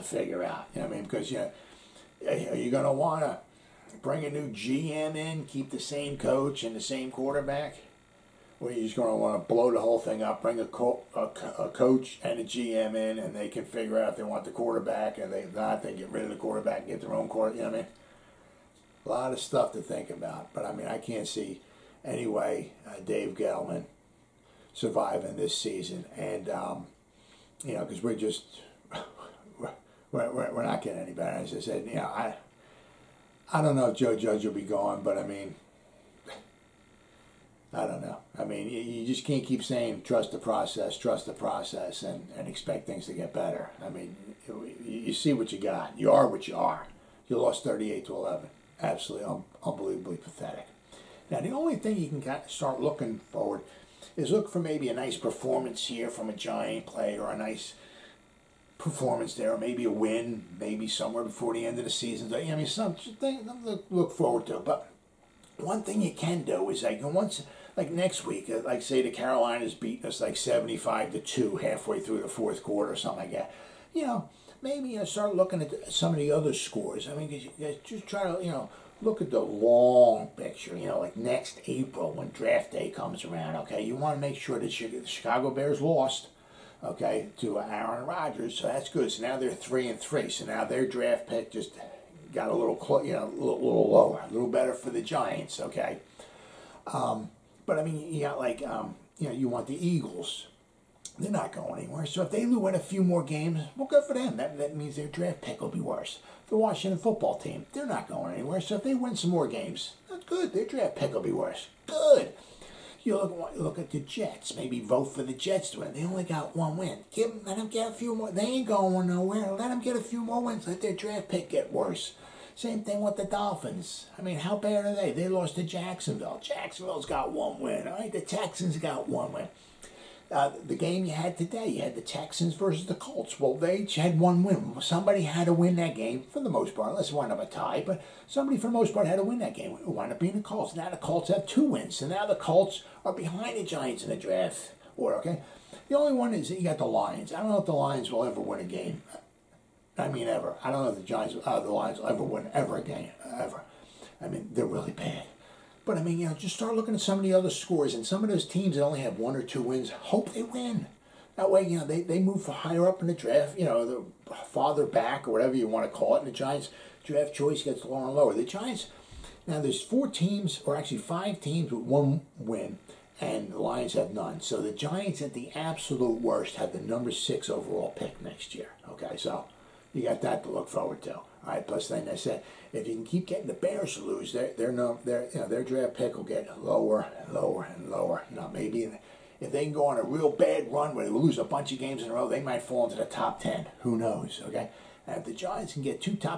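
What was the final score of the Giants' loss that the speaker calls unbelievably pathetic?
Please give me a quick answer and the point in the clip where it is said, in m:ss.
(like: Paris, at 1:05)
38 to 11, at 0:47.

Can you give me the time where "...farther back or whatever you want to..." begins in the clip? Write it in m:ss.
2:44.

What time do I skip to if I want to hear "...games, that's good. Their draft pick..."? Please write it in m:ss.
1:49.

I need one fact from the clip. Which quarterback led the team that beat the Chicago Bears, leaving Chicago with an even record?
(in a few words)
Aaron Rodgers.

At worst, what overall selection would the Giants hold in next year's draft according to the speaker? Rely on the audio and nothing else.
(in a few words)
6.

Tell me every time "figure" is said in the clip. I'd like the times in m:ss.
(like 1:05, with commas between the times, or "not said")
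0:00, 0:13.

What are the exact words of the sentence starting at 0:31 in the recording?
As I said, you know, I.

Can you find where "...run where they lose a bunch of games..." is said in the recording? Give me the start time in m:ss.
3:10.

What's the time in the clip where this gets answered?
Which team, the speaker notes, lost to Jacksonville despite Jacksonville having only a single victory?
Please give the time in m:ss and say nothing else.
2:03.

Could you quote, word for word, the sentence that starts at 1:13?
You know, maybe you uh, know, start looking at some of the other scores.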